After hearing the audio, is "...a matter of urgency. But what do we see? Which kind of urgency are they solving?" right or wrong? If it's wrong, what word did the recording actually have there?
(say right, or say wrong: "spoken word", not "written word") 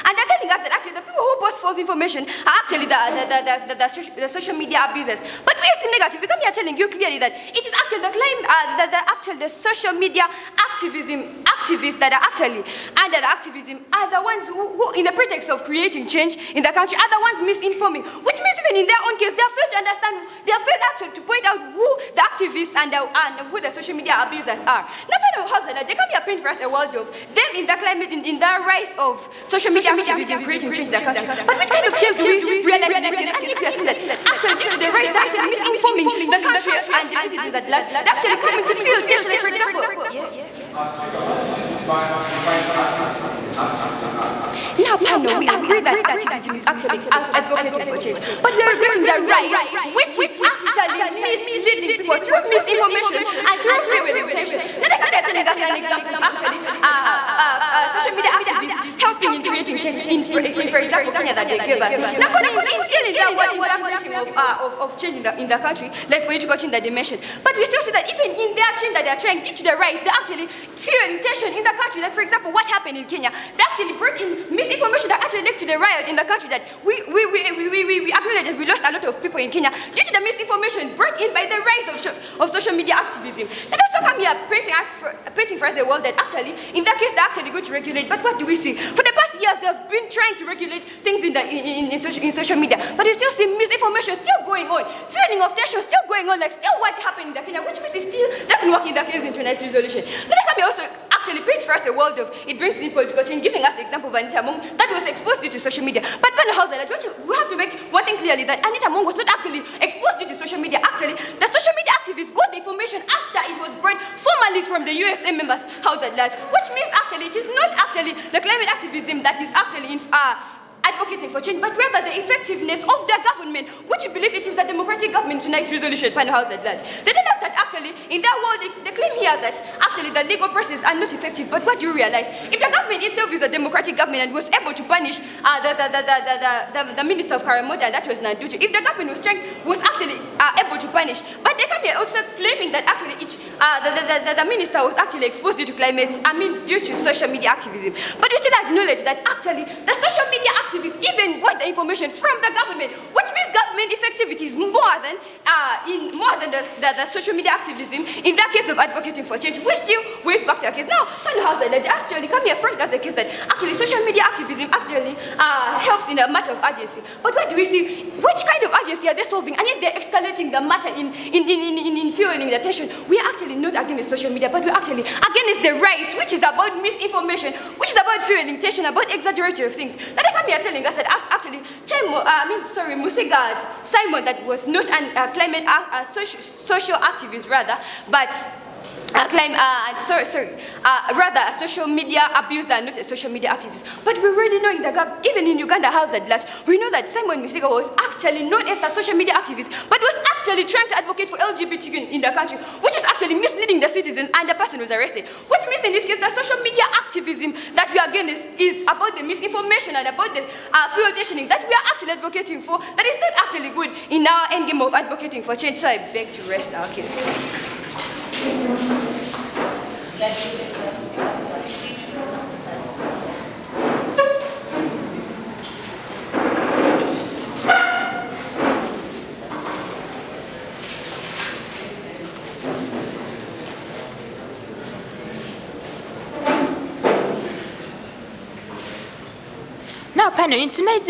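right.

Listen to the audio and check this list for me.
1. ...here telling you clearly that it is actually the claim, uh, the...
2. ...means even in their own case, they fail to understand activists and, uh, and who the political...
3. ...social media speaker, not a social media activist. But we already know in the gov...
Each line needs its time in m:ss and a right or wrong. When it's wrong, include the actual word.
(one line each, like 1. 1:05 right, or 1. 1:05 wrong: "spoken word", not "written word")
1. 0:06 right
2. 0:18 wrong: "social", not "political"
3. 3:11 wrong: "abuser", not "speaker".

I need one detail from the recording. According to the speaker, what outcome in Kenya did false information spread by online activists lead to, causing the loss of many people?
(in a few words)
riot.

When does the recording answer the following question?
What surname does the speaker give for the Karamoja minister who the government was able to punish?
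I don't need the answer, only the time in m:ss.
2:18.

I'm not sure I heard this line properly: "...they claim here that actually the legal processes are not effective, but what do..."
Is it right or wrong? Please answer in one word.
right.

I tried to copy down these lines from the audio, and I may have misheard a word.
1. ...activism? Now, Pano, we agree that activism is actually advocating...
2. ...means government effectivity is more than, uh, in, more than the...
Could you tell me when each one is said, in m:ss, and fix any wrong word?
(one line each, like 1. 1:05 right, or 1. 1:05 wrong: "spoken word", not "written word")
1. 0:42 right
2. 2:33 right.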